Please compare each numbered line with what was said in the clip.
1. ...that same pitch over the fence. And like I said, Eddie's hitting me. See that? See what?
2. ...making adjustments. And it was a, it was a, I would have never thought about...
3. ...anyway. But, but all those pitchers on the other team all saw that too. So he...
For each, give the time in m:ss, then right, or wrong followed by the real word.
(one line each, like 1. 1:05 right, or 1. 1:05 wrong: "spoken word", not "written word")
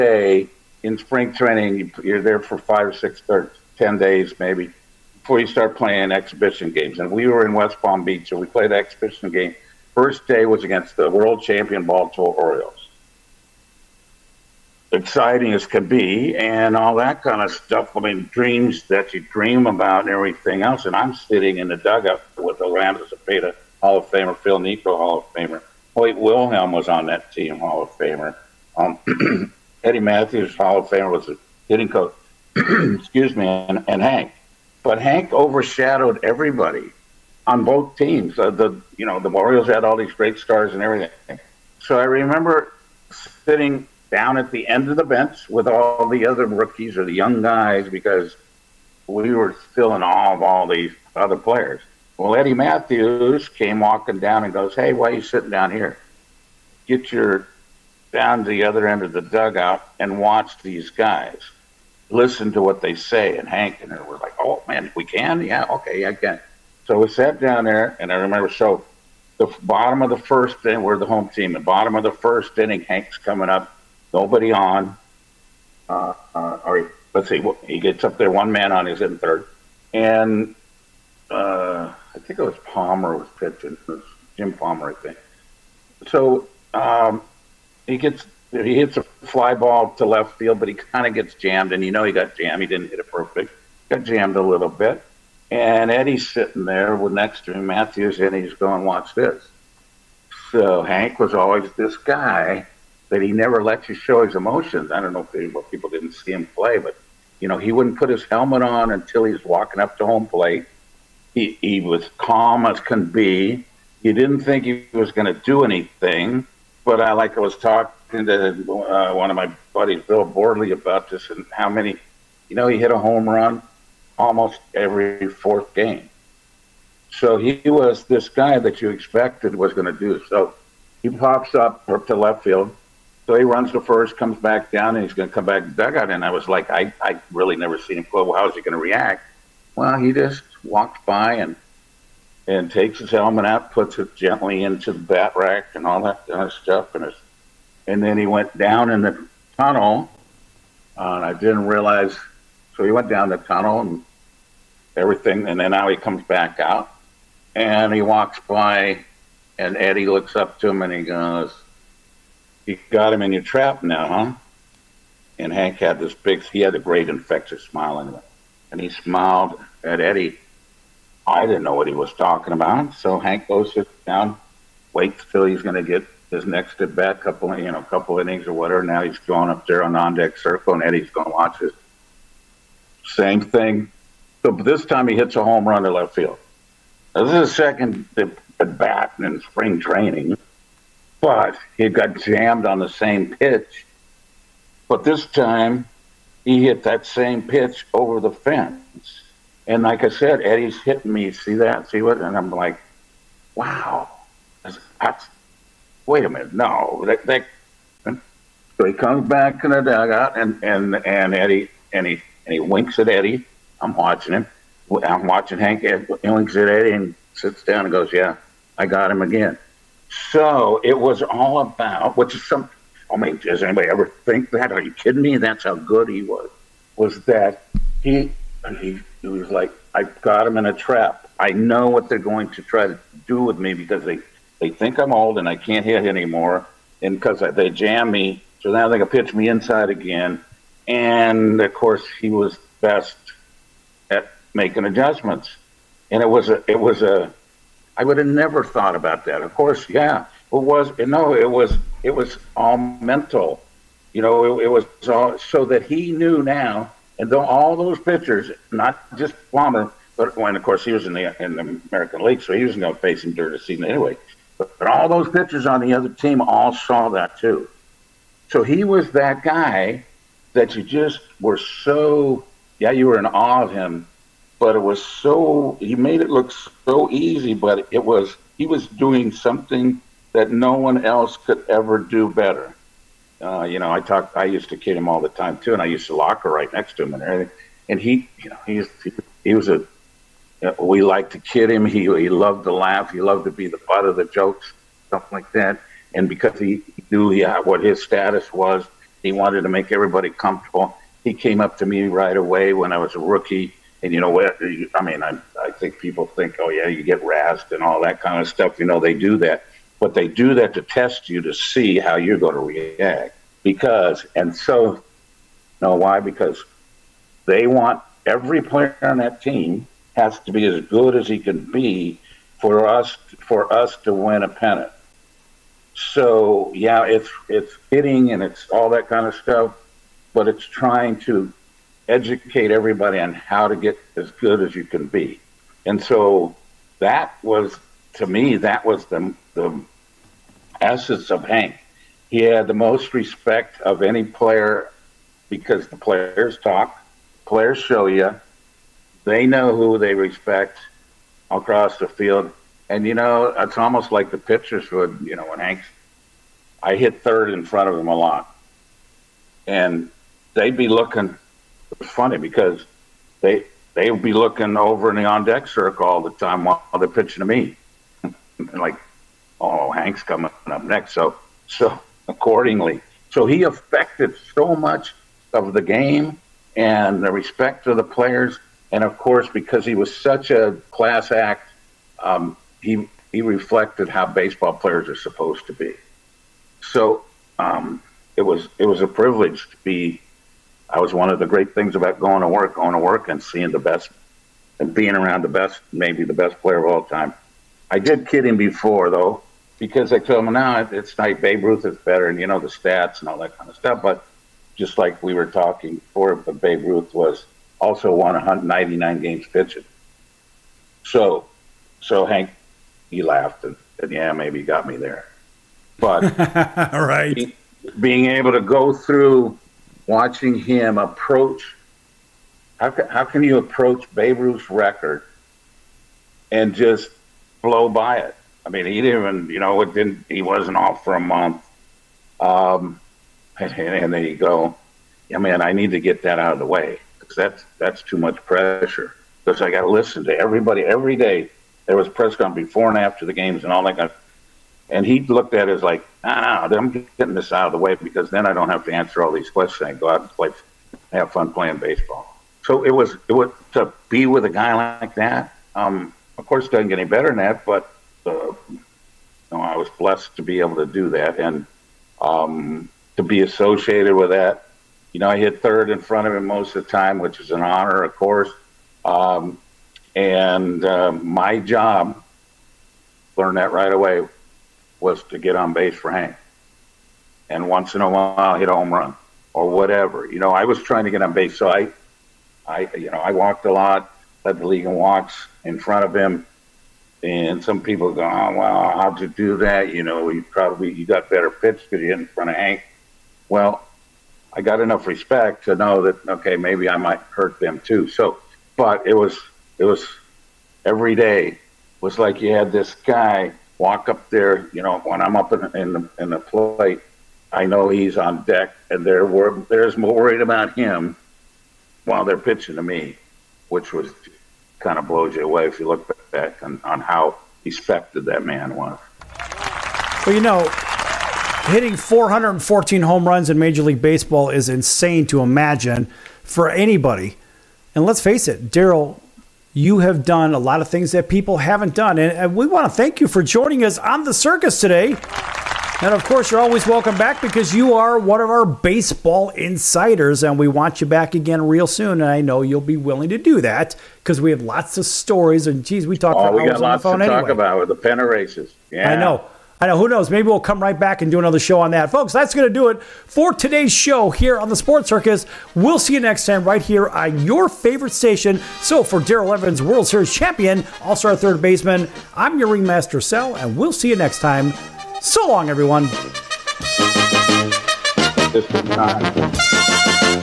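1. 3:16 right
2. 4:04 right
3. 4:23 right.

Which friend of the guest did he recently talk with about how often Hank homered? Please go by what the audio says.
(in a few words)
Bill Bordley.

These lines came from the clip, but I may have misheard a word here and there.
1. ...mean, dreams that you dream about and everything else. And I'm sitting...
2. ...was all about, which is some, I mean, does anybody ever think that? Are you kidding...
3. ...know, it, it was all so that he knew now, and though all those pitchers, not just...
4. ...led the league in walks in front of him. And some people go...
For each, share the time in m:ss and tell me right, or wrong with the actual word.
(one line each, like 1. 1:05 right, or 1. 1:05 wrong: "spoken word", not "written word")
1. 0:17 right
2. 3:40 right
3. 4:14 right
4. 8:04 right.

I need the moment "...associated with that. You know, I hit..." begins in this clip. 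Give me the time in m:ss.
7:43.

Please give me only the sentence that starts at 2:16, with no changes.
And I was like, I, I really never seen him play.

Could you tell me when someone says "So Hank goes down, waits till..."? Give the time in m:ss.
2:52.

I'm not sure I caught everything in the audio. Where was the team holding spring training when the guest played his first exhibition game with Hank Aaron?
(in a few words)
West Palm Beach.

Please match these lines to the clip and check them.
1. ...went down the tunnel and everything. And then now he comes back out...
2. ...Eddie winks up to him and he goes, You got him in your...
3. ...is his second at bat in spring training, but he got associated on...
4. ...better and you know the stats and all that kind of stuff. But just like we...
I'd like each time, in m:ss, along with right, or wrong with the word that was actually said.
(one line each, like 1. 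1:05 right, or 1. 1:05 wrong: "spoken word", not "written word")
1. 2:32 right
2. 2:39 wrong: "looks", not "winks"
3. 3:07 wrong: "jammed", not "associated"
4. 6:41 right.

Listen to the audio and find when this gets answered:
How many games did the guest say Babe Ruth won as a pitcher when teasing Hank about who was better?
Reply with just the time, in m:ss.
6:48.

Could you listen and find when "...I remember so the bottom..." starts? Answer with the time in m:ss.
1:08.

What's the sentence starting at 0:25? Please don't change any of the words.
Hoyt Wilhelm was on that team, Hall of Famer.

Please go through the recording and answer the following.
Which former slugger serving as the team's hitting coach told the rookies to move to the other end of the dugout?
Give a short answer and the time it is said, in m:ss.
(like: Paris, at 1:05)
Eddie Mathews, at 0:52.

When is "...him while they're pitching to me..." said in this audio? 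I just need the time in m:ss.
8:30.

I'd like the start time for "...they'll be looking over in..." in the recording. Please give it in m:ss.
6:03.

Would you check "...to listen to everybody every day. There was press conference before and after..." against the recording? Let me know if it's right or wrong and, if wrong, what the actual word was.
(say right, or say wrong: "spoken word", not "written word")
right.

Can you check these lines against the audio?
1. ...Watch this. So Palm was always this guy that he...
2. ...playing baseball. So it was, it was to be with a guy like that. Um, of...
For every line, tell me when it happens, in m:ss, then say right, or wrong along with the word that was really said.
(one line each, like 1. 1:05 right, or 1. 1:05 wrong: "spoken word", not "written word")
1. 1:38 wrong: "Hank", not "Palm"
2. 7:31 right.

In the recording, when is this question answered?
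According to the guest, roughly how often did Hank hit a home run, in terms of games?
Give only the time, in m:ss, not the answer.
2:04.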